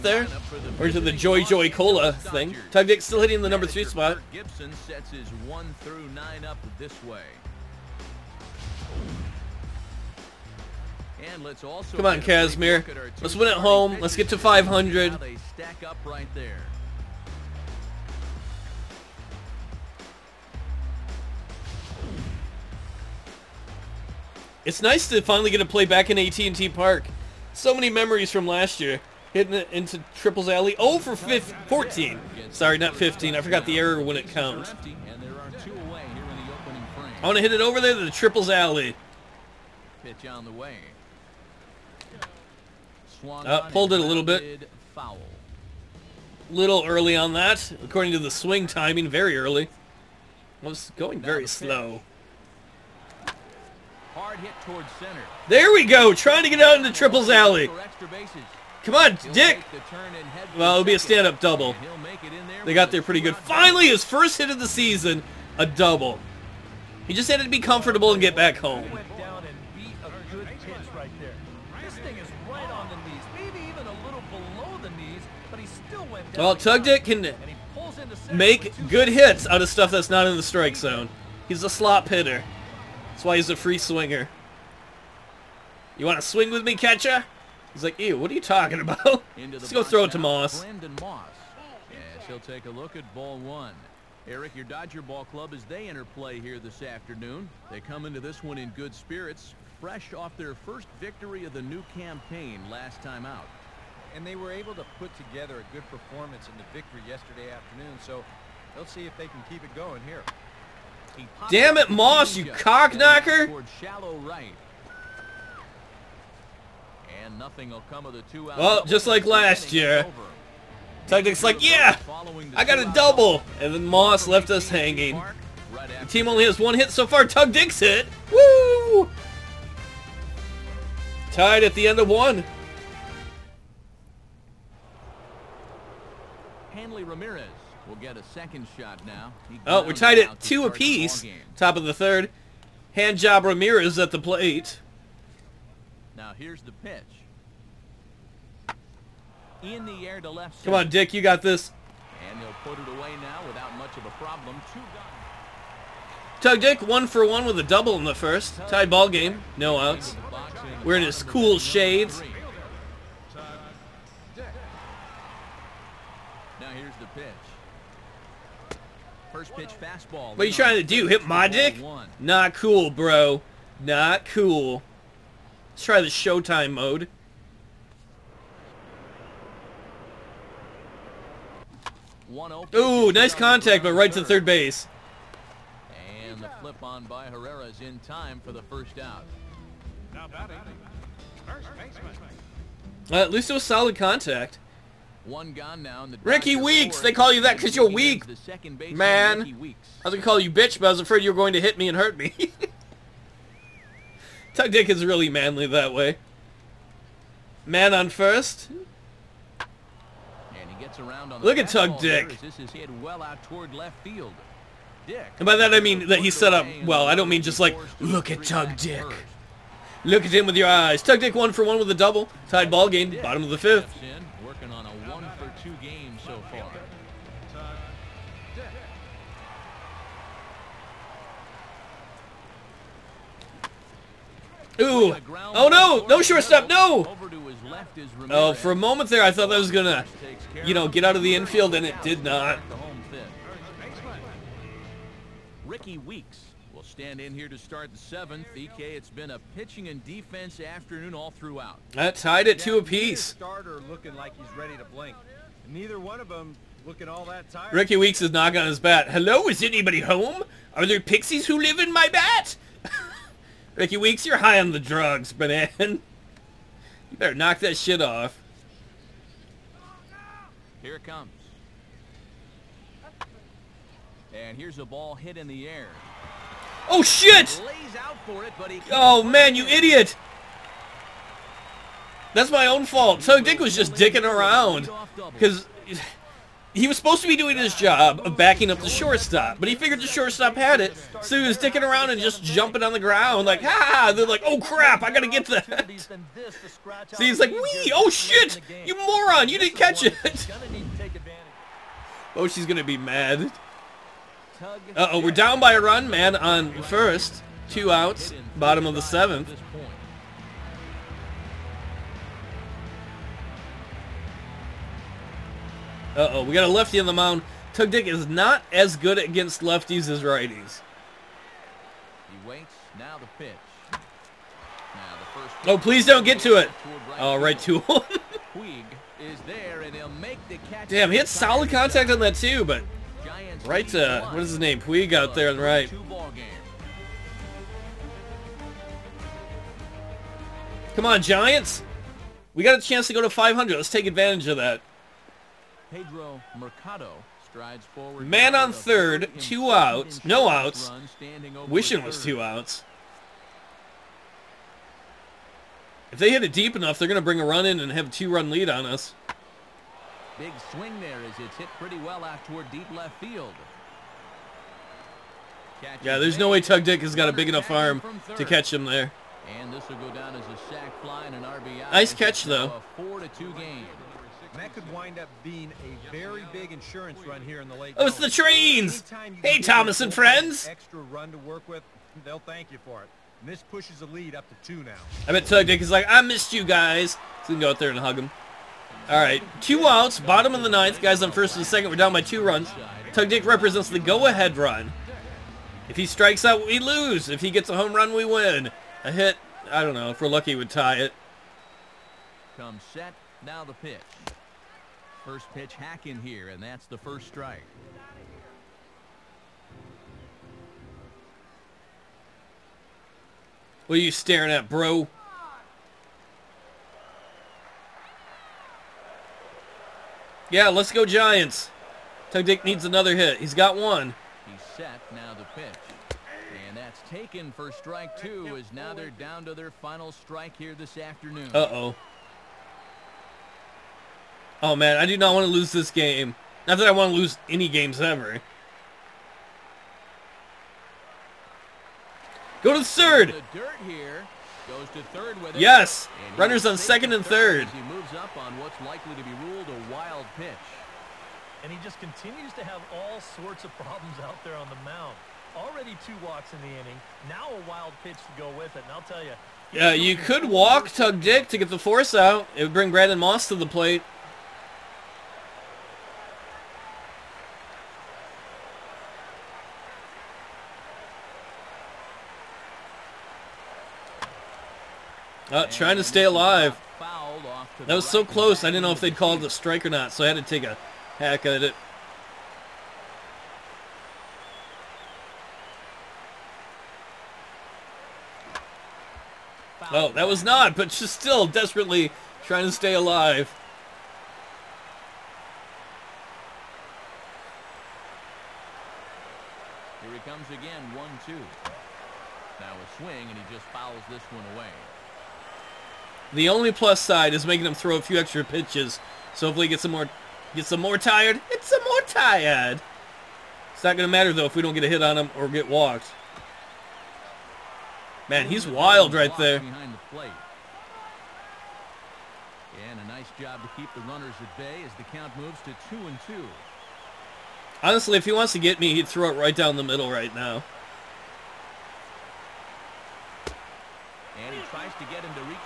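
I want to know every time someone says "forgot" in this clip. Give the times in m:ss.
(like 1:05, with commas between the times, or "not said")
0:33.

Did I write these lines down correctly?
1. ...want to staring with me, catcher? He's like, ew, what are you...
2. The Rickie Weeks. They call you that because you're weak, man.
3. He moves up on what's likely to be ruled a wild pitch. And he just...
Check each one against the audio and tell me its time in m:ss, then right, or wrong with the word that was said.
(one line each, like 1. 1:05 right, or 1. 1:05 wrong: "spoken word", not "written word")
1. 1:26 wrong: "swing", not "staring"
2. 3:16 right
3. 7:27 right.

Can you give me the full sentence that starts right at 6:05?
Catches yeah, there's no way Tug Dick has got a big enough arm to catch him there.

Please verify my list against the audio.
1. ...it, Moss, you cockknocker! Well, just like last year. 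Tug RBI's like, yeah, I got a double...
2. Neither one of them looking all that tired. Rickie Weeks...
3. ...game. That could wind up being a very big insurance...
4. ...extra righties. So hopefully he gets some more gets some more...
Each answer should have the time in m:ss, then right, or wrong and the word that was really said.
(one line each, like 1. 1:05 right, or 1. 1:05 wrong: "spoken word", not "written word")
1. 1:51 wrong: "Dick", not "RBI"
2. 4:15 right
3. 6:13 right
4. 8:28 wrong: "pitches", not "righties".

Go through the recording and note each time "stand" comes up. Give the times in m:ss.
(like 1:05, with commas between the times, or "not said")
1:00, 4:06.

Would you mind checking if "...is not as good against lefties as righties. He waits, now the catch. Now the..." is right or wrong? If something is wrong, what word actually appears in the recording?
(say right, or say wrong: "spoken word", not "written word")
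wrong: "pitch", not "catch".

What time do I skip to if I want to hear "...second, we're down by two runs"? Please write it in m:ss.
6:31.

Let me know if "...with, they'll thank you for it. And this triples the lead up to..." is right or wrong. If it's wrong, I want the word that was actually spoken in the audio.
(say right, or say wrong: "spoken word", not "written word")
wrong: "pushes", not "triples".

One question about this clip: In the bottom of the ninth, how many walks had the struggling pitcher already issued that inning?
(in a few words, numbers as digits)
2.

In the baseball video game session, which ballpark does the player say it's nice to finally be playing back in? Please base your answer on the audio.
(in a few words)
AT&T Park.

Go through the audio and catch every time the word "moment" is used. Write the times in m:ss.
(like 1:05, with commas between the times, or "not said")
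3:58.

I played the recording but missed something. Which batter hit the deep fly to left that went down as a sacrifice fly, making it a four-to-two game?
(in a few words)
Pedro Mercado.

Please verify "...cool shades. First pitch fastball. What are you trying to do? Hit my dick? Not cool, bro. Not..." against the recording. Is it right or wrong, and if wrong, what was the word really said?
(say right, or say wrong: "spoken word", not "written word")
right.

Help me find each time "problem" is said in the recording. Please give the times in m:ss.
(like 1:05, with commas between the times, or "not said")
2:34, 7:33.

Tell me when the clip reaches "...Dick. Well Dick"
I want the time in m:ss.
3:31.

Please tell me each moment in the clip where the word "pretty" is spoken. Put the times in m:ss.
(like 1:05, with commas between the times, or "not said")
1:03, 6:01.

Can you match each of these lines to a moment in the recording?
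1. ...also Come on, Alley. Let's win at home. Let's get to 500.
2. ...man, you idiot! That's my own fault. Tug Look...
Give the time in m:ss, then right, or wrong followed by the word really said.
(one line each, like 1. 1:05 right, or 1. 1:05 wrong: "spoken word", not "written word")
1. 0:11 wrong: "Kazmir", not "Alley"
2. 4:39 wrong: "Dick", not "Look".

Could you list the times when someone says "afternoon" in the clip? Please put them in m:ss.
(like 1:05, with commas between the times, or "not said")
1:36, 1:47, 4:10, 7:10.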